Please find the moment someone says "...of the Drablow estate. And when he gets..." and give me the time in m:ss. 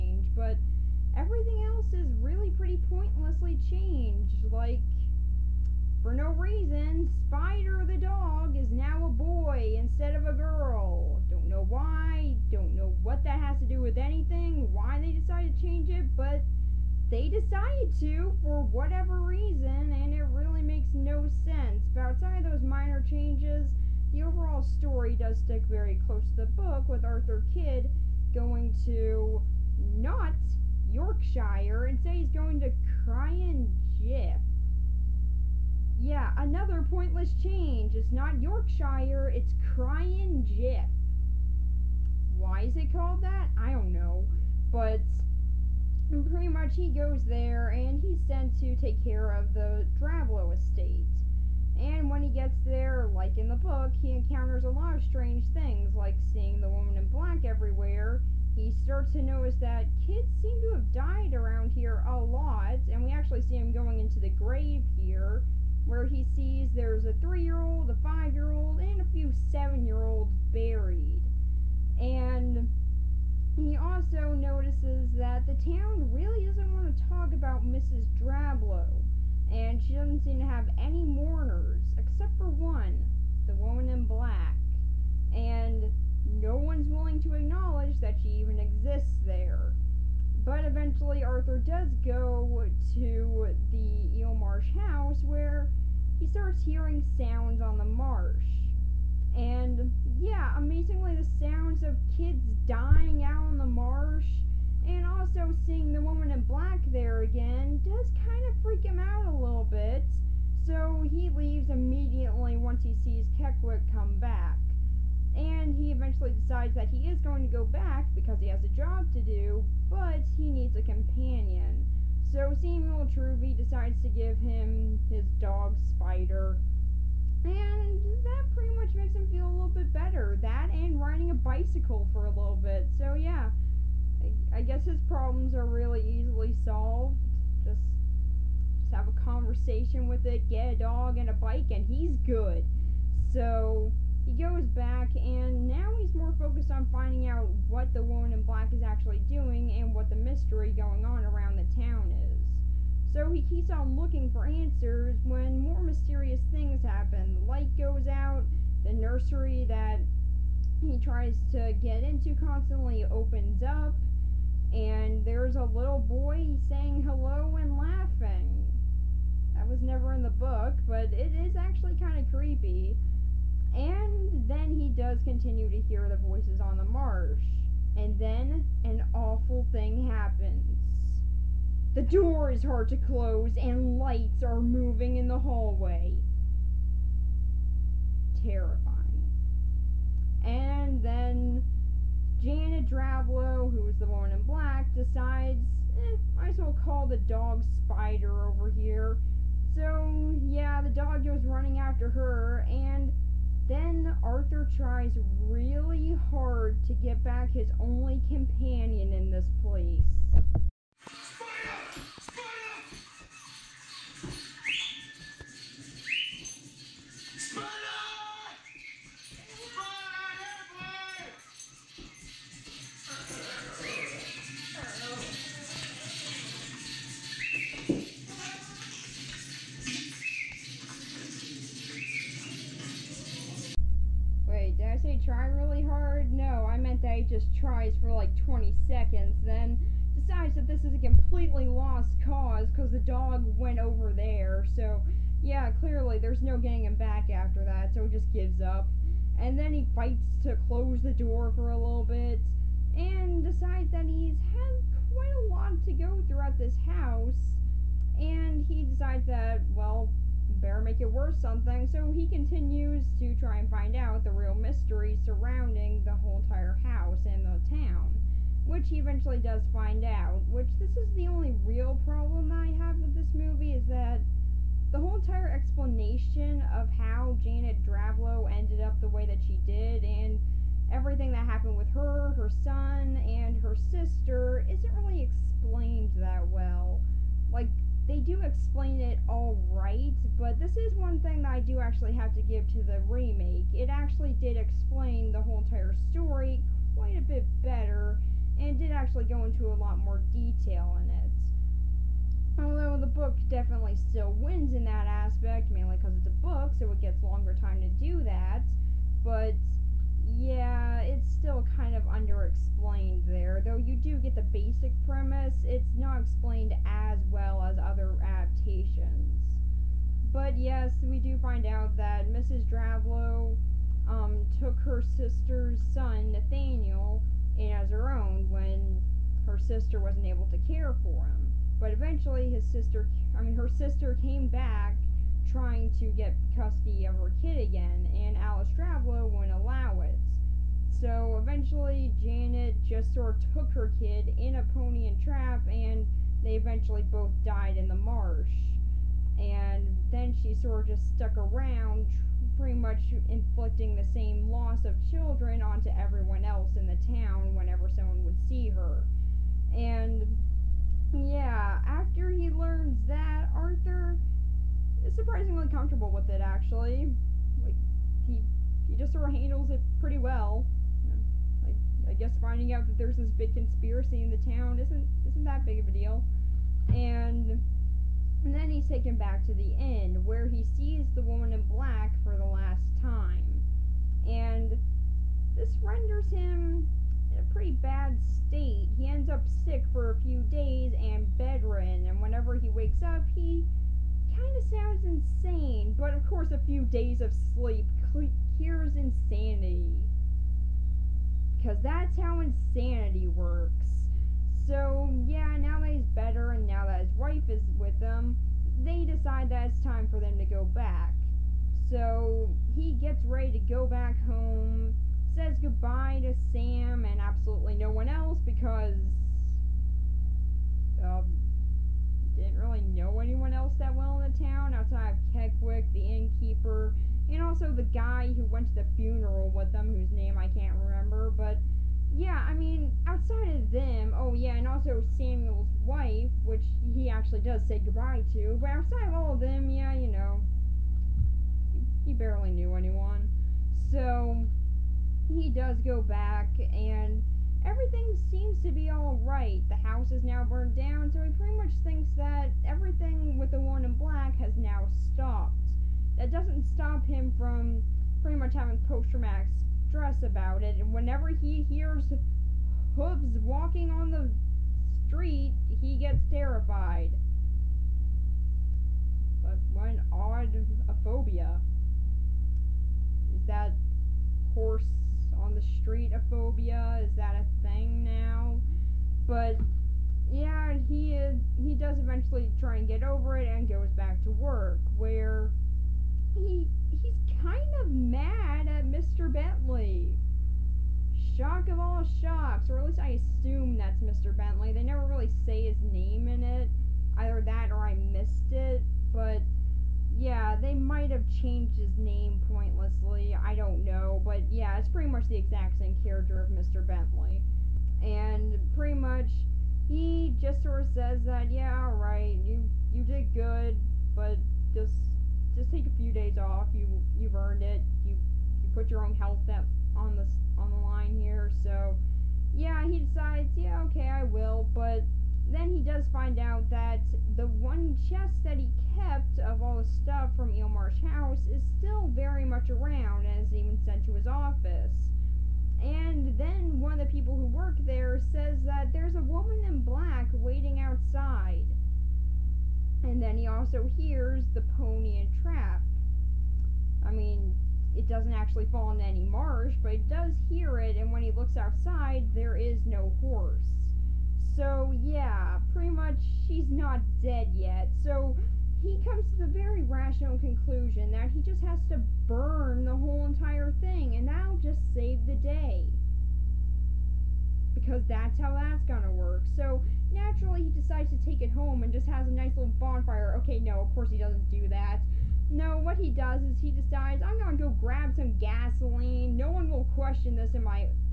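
0:49.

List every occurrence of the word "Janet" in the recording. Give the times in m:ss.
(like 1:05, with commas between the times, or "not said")
3:12, 4:37, 5:42.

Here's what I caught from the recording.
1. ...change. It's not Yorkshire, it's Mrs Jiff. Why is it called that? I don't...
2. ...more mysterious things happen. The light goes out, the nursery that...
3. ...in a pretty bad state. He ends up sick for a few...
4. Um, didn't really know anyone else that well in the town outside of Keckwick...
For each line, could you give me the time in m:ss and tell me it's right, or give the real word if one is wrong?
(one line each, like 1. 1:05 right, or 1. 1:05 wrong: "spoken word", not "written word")
1. 0:37 wrong: "Cryan", not "Mrs"
2. 2:35 right
3. 6:27 right
4. 7:01 right.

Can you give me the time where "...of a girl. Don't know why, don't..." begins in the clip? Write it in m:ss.
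0:10.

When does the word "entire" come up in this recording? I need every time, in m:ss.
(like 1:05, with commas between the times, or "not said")
4:26, 4:35, 4:55, 9:23.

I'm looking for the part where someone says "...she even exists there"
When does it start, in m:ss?
1:28.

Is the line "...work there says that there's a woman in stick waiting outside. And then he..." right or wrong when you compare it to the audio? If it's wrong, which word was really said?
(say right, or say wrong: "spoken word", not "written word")
wrong: "black", not "stick".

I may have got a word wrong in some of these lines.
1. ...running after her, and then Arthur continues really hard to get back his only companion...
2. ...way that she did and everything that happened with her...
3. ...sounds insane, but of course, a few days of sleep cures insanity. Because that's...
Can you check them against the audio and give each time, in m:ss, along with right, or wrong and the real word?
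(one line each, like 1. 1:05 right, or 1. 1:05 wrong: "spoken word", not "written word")
1. 3:21 wrong: "tries", not "continues"
2. 4:39 right
3. 6:34 right.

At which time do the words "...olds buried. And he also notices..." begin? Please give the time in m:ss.
1:10.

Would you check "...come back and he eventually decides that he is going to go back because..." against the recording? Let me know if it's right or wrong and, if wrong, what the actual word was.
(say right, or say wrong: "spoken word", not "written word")
right.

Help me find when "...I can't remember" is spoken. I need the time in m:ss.
7:10.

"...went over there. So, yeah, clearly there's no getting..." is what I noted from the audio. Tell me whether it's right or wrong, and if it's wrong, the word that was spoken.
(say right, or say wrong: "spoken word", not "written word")
right.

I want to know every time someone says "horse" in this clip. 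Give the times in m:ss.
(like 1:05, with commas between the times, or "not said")
7:54, 9:13.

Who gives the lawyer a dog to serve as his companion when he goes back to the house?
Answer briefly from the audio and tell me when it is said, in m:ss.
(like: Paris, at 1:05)
Samuel Truvy, at 2:02.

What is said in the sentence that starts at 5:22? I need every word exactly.
Drablow um, took her sister's son, Nathaniel, in as her own when her sister wasn't able to care for him.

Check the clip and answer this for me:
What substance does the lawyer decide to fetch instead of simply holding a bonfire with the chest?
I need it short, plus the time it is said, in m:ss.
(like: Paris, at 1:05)
gasoline, at 9:38.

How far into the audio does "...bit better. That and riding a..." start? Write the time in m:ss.
2:09.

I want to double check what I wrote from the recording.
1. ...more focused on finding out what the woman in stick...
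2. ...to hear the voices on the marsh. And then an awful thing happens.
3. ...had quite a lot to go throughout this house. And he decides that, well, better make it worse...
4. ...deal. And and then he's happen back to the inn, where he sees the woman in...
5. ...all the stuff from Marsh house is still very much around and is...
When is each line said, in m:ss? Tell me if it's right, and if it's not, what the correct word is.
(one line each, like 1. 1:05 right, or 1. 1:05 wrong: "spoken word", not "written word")
1. 2:26 wrong: "black", not "stick"
2. 2:55 right
3. 4:14 right
4. 6:15 wrong: "taken", not "happen"
5. 8:49 right.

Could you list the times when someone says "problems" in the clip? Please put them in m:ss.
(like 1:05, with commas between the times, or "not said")
2:15, 4:32.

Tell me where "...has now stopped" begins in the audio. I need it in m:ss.
7:34.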